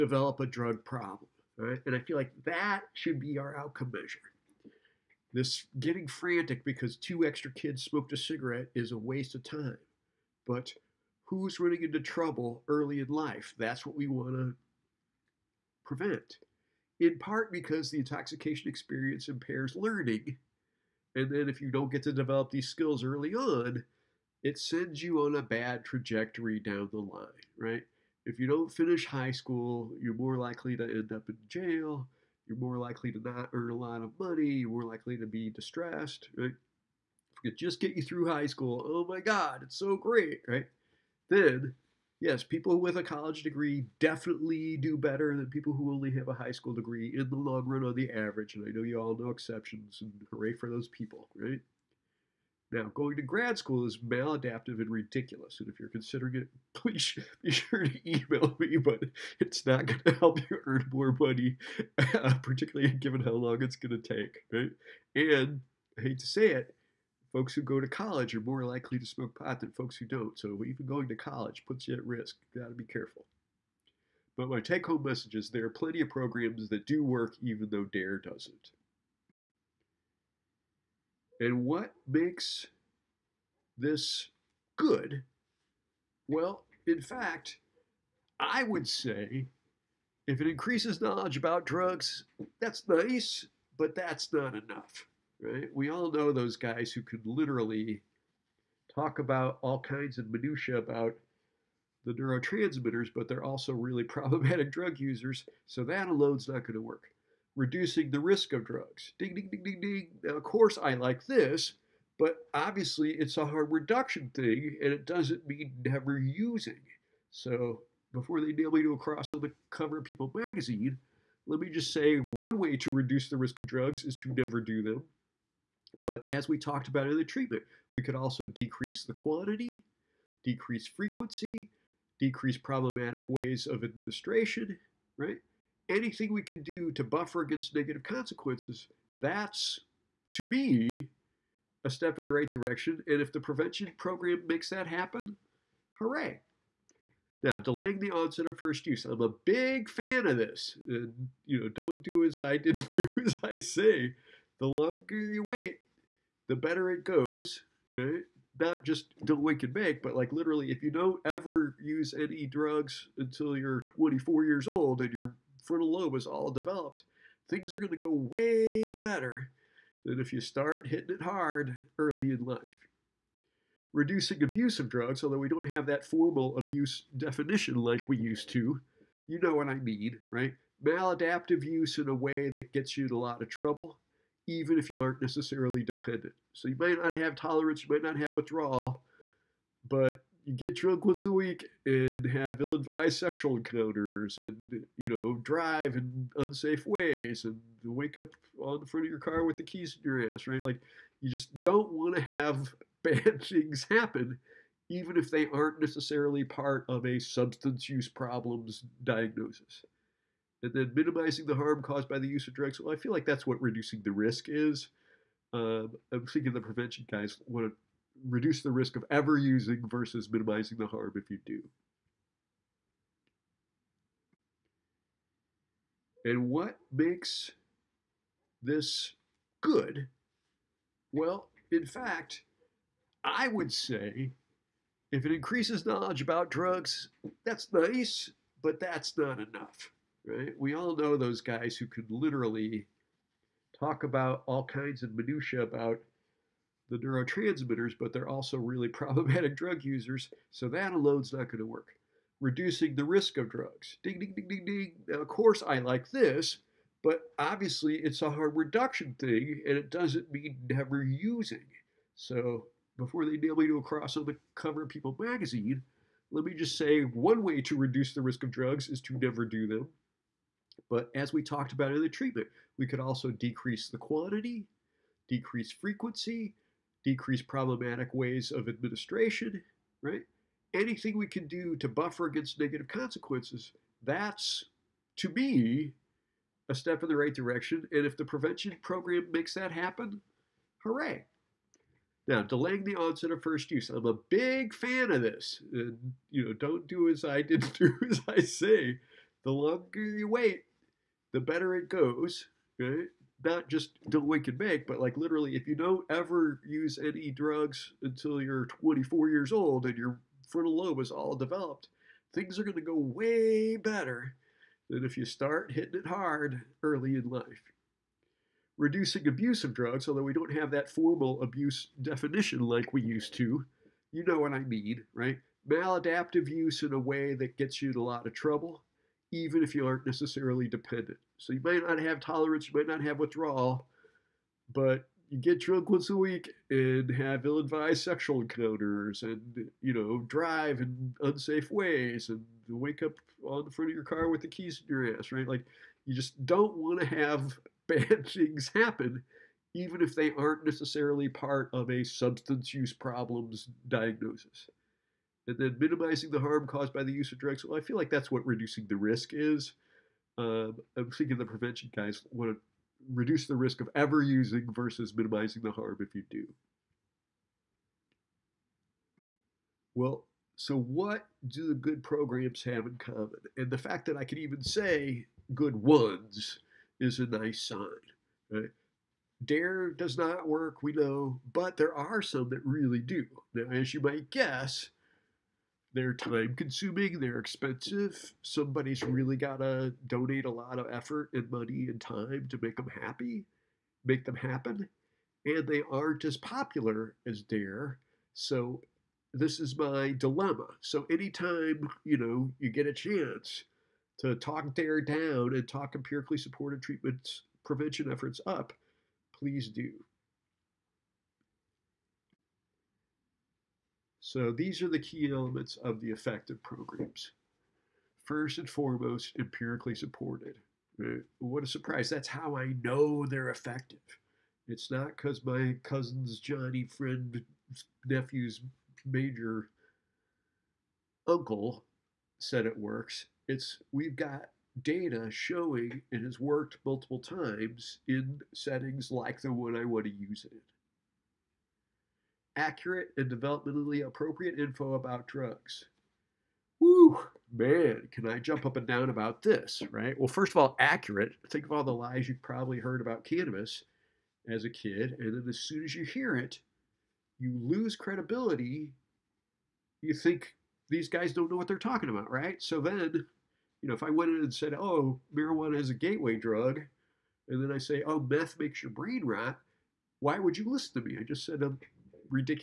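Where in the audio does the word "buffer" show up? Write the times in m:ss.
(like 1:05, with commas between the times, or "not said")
2:17, 4:41.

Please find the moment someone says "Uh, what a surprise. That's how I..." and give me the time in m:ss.
7:01.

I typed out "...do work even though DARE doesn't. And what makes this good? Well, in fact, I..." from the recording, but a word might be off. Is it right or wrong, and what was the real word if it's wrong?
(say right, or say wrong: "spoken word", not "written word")
right.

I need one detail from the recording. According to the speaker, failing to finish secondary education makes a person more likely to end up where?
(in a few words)
jail.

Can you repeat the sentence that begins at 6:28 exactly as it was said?
Somebody's really got to donate a lot of effort and money and time to make them happy, make them happen.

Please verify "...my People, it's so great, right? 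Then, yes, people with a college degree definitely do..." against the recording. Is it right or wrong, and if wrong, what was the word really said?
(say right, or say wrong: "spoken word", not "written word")
wrong: "God", not "People".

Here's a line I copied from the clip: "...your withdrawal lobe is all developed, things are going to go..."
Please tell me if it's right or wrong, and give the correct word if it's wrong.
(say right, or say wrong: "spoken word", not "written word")
wrong: "frontal", not "withdrawal".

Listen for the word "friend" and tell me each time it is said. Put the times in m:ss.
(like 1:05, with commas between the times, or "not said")
7:06.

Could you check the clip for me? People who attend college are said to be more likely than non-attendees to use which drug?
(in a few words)
pot.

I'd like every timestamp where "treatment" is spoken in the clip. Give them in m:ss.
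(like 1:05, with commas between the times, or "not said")
2:07, 4:32, 6:46.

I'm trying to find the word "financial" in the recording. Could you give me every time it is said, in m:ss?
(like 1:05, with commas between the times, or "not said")
not said.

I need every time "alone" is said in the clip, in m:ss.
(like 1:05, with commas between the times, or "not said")
1:46, 4:10.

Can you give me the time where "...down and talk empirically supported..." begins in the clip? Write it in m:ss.
6:45.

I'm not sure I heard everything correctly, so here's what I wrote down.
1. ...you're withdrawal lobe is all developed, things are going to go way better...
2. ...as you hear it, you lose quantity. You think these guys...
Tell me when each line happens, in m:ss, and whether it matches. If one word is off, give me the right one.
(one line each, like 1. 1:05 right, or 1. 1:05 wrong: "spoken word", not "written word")
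1. 2:45 wrong: "frontal", not "withdrawal"
2. 7:35 wrong: "credibility", not "quantity".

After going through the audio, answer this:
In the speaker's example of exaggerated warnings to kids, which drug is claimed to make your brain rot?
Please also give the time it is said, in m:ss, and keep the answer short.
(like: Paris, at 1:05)
meth, at 7:48.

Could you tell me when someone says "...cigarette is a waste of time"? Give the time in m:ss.
0:08.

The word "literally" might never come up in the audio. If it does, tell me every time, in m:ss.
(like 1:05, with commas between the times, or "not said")
1:37, 2:40, 4:02, 5:05.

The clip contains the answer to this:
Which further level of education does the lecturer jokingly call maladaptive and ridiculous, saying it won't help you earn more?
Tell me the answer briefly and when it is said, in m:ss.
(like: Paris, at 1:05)
grad school, at 0:53.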